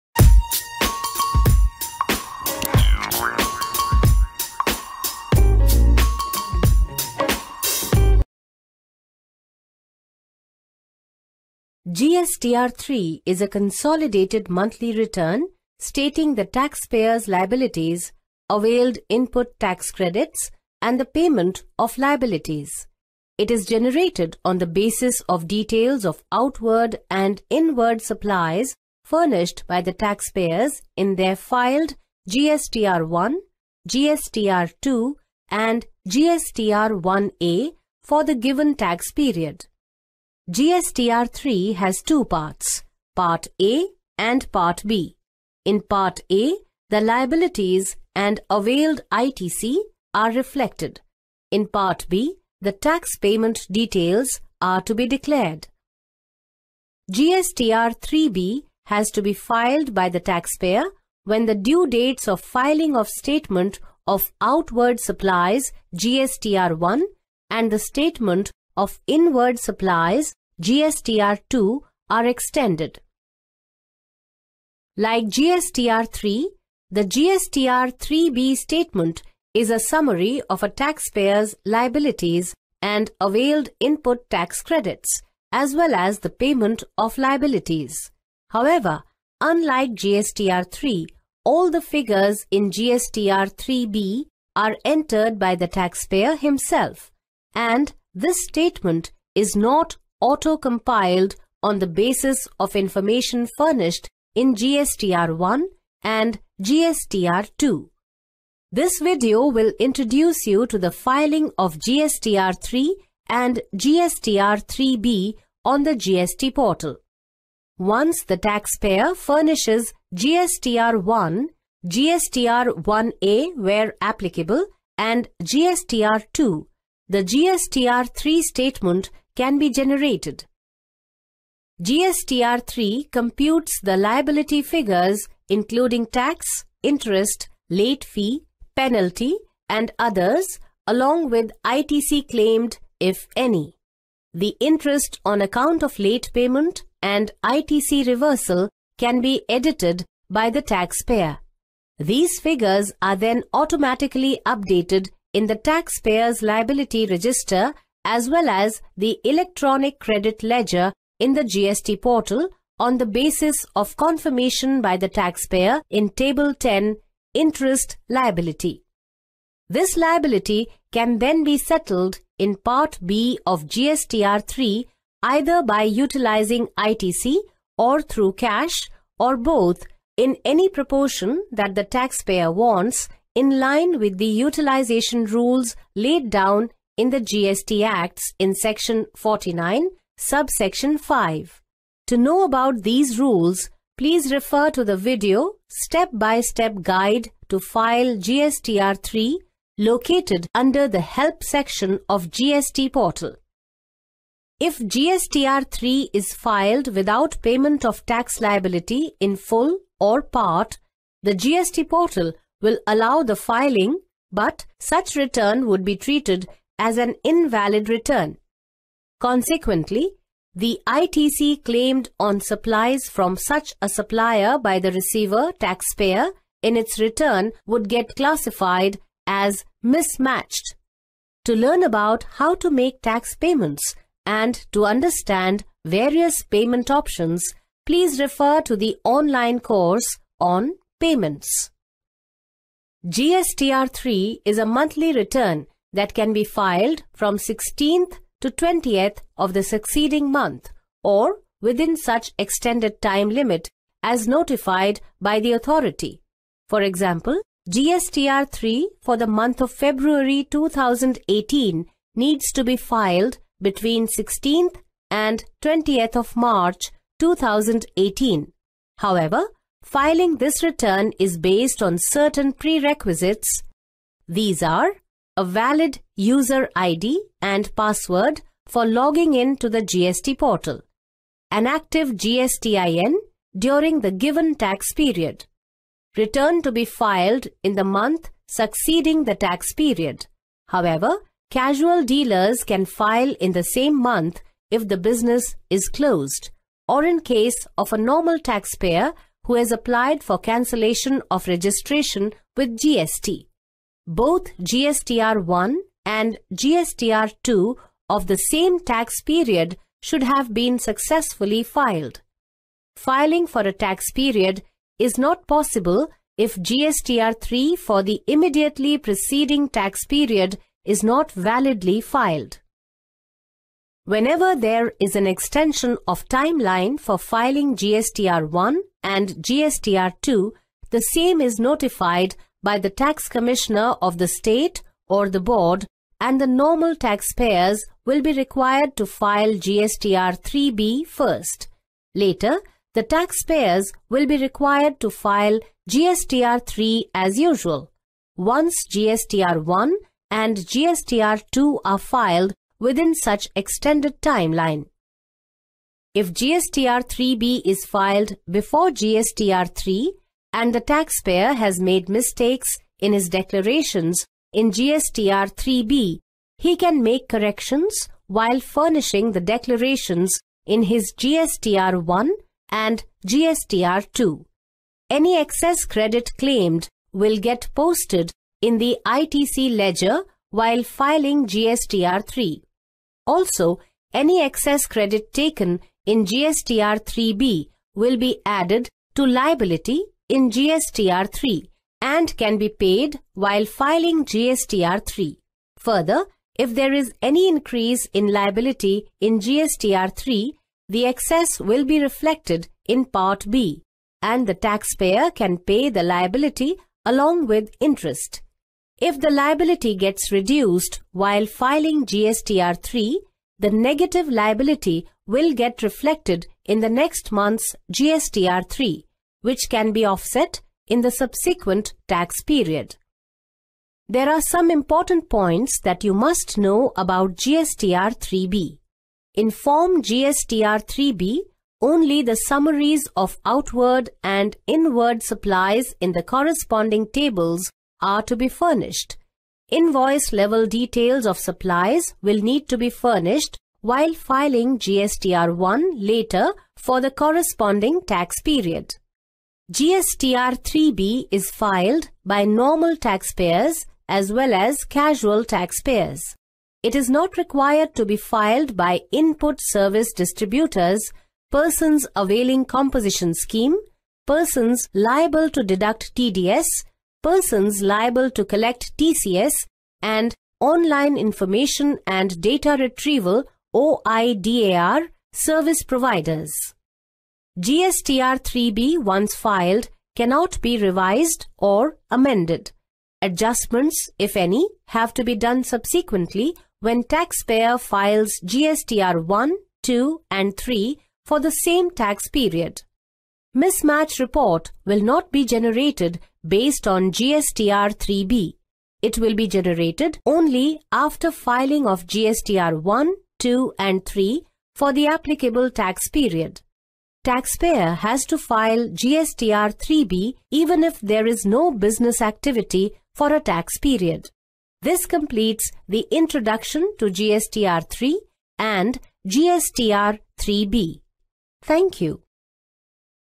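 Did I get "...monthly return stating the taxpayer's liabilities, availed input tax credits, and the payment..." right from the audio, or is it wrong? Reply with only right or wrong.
right.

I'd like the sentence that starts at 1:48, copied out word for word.
This video will introduce you to the filing of GSTR 3 and GSTR 3B on the GST portal.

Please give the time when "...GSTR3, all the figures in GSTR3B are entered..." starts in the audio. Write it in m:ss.
1:29.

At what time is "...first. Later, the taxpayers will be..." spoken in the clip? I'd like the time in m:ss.
5:41.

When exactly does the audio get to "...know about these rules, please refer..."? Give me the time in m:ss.
3:12.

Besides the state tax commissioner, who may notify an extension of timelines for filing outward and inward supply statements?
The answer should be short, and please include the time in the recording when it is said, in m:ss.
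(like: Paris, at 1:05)
the board, at 5:35.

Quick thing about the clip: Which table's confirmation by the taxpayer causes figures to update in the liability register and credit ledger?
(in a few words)
Table 10.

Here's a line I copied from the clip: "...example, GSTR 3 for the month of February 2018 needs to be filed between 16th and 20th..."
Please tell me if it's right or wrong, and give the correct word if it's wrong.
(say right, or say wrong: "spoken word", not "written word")
right.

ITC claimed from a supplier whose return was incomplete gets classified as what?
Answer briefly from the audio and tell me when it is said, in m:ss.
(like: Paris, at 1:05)
mismatched, at 3:49.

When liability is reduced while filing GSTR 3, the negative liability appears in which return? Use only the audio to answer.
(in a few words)
next month's GSTR 3.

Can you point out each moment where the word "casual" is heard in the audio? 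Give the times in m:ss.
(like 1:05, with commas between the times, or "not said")
4:51, 7:34.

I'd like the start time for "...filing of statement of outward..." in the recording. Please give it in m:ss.
1:02.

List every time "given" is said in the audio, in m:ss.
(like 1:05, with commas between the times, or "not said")
0:38, 4:44.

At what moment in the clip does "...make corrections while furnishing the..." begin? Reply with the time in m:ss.
6:07.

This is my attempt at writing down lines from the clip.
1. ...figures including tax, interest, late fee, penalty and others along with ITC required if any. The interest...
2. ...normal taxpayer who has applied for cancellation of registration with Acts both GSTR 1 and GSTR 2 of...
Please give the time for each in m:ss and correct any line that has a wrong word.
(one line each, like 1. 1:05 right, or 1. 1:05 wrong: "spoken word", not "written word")
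1. 2:14 wrong: "claimed", not "required"
2. 4:57 wrong: "GST", not "Acts".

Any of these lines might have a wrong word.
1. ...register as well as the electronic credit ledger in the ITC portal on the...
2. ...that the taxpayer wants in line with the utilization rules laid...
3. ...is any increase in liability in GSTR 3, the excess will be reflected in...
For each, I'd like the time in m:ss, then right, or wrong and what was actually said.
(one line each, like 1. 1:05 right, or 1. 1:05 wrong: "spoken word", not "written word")
1. 2:37 wrong: "GST", not "ITC"
2. 3:01 right
3. 6:36 right.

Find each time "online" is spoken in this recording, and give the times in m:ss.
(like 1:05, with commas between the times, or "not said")
3:59, 7:50.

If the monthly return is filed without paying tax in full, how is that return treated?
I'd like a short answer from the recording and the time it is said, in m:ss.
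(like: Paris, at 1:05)
invalid return, at 3:37.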